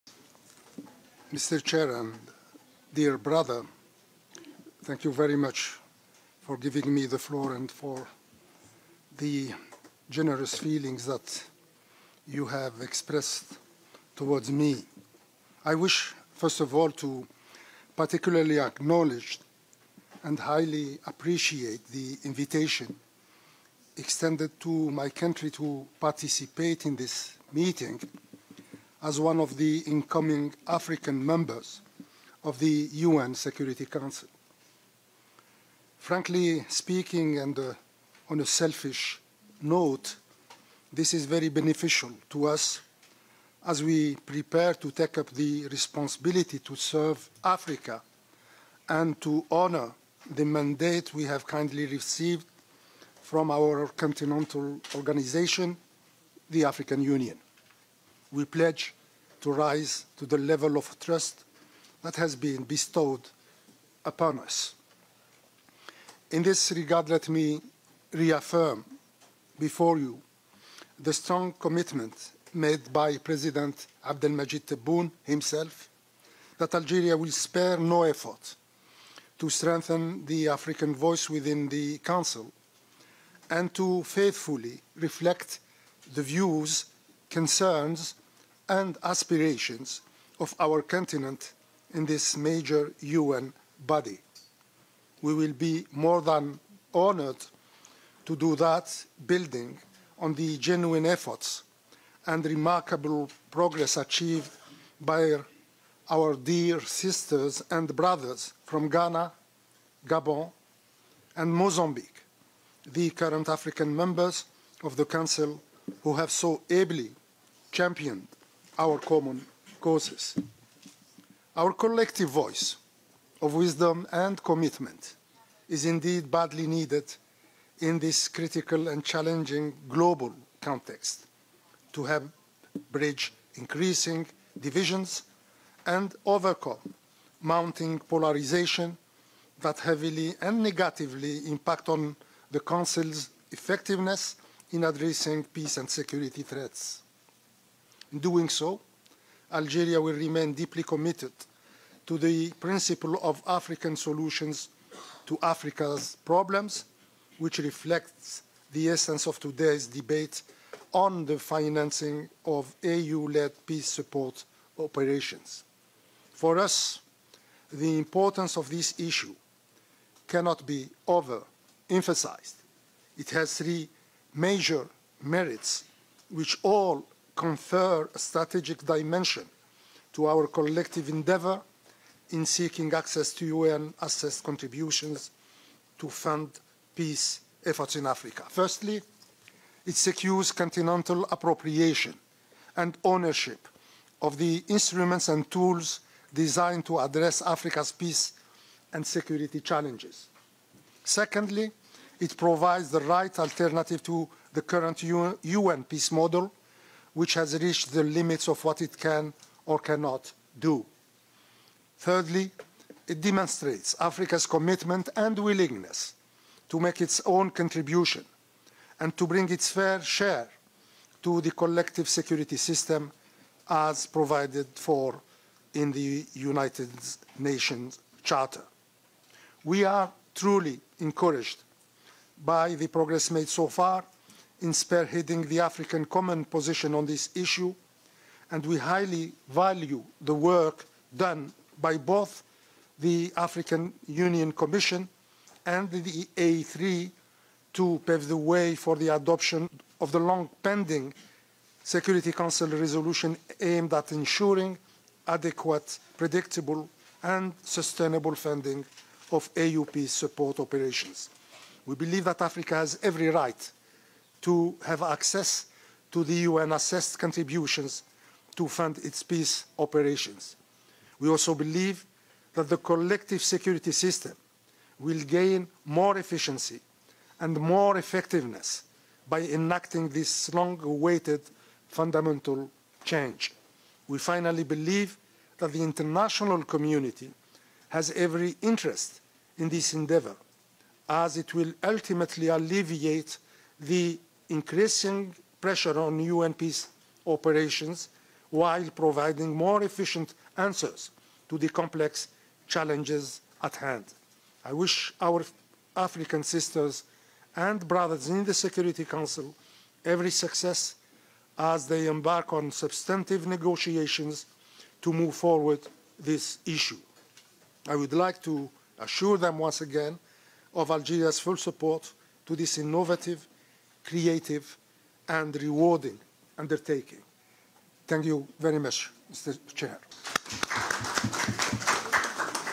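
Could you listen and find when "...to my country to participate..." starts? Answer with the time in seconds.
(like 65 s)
24 s.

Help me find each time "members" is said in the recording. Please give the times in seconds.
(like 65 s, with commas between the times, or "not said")
31 s, 113 s.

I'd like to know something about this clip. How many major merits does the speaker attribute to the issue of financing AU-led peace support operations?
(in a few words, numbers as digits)
3.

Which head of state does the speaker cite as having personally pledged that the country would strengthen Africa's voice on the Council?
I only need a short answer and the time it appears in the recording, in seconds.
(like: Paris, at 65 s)
Abdelmajid Tebboune, at 74 s.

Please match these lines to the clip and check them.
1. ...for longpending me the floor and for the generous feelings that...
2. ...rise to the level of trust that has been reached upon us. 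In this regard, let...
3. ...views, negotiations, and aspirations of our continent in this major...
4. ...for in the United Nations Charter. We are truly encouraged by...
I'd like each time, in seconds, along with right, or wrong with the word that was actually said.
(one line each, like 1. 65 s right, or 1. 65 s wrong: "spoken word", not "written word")
1. 6 s wrong: "giving", not "longpending"
2. 59 s wrong: "bestowed", not "reached"
3. 86 s wrong: "concerns", not "negotiations"
4. 224 s right.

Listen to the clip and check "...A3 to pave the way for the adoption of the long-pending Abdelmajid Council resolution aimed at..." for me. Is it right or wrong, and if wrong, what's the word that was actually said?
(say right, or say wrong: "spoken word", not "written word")
wrong: "Security", not "Abdelmajid".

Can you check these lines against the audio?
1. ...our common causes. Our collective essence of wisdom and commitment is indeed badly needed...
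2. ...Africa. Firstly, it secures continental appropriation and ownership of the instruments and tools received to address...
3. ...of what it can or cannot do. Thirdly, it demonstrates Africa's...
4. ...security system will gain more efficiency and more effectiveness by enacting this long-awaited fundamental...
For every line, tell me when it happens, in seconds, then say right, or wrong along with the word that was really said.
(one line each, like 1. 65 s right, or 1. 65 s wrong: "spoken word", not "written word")
1. 118 s wrong: "voice", not "essence"
2. 188 s wrong: "designed", not "received"
3. 208 s right
4. 273 s right.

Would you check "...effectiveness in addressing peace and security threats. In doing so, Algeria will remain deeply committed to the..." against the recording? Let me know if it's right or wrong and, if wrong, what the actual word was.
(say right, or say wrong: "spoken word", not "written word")
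right.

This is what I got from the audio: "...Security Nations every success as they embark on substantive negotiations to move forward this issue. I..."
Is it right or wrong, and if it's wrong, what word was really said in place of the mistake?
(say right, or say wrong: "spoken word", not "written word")
wrong: "Council", not "Nations".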